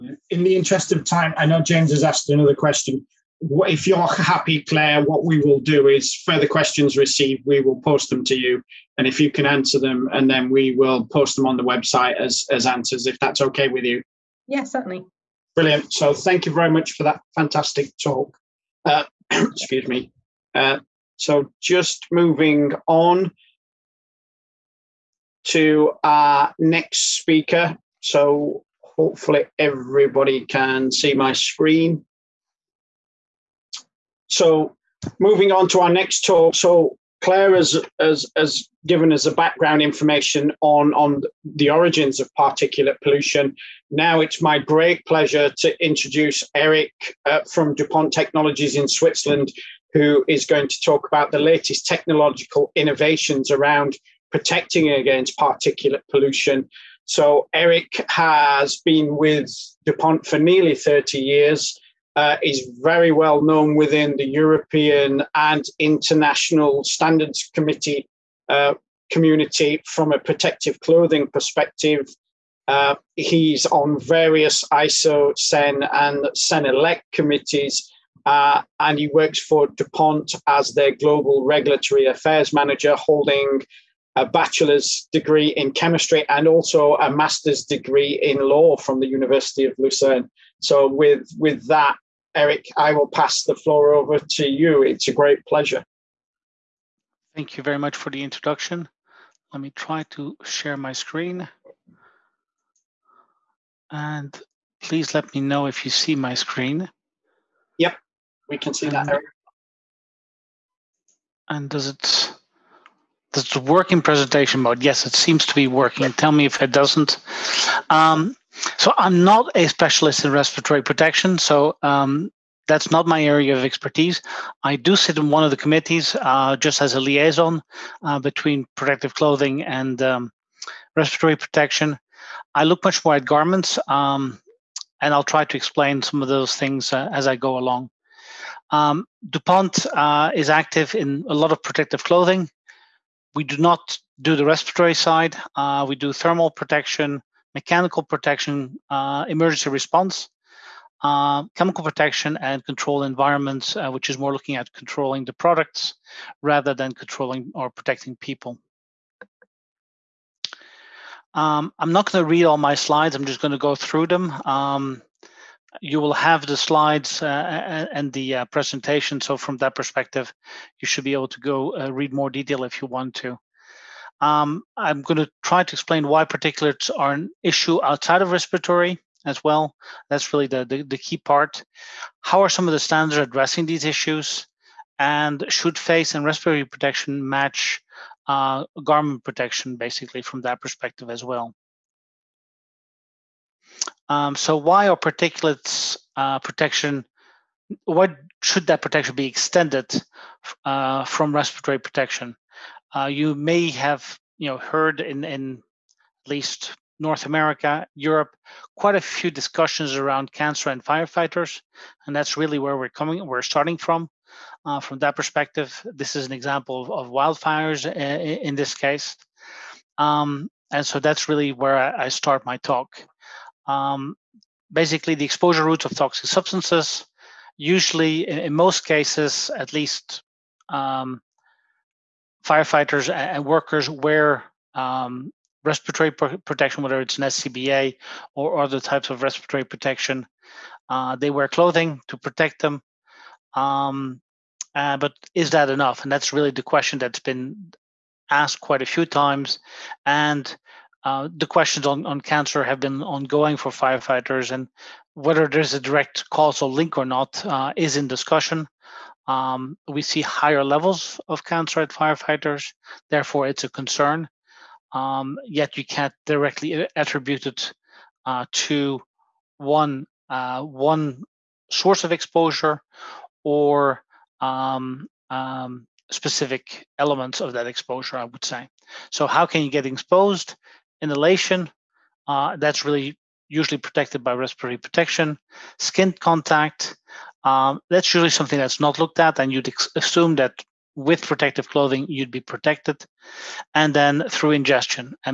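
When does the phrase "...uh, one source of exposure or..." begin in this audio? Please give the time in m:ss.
4:30.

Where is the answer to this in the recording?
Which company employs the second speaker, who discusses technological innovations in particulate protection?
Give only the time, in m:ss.
0:47.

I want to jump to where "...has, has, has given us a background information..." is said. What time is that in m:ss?
0:37.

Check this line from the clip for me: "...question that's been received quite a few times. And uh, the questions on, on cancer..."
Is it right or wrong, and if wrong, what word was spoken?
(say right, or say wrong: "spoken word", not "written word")
wrong: "asked", not "received".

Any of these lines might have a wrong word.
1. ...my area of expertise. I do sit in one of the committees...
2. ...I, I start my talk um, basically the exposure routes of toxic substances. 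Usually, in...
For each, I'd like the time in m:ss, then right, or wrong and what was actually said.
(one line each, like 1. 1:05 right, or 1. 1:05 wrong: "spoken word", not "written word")
1. 2:03 right
2. 3:41 right.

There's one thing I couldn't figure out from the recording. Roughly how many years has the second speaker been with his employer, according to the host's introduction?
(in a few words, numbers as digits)
30.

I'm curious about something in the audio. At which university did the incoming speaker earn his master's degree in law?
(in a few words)
University of Lucerne.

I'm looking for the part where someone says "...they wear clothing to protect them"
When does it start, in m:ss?
4:01.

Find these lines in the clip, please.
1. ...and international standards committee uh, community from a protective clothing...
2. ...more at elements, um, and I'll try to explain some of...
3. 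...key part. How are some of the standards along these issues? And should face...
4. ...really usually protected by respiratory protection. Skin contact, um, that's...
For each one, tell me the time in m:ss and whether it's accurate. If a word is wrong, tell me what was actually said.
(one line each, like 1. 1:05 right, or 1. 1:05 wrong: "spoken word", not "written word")
1. 1:05 right
2. 2:13 wrong: "garments", not "elements"
3. 3:00 wrong: "addressing", not "along"
4. 4:42 right.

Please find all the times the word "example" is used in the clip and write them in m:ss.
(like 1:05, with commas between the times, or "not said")
3:36.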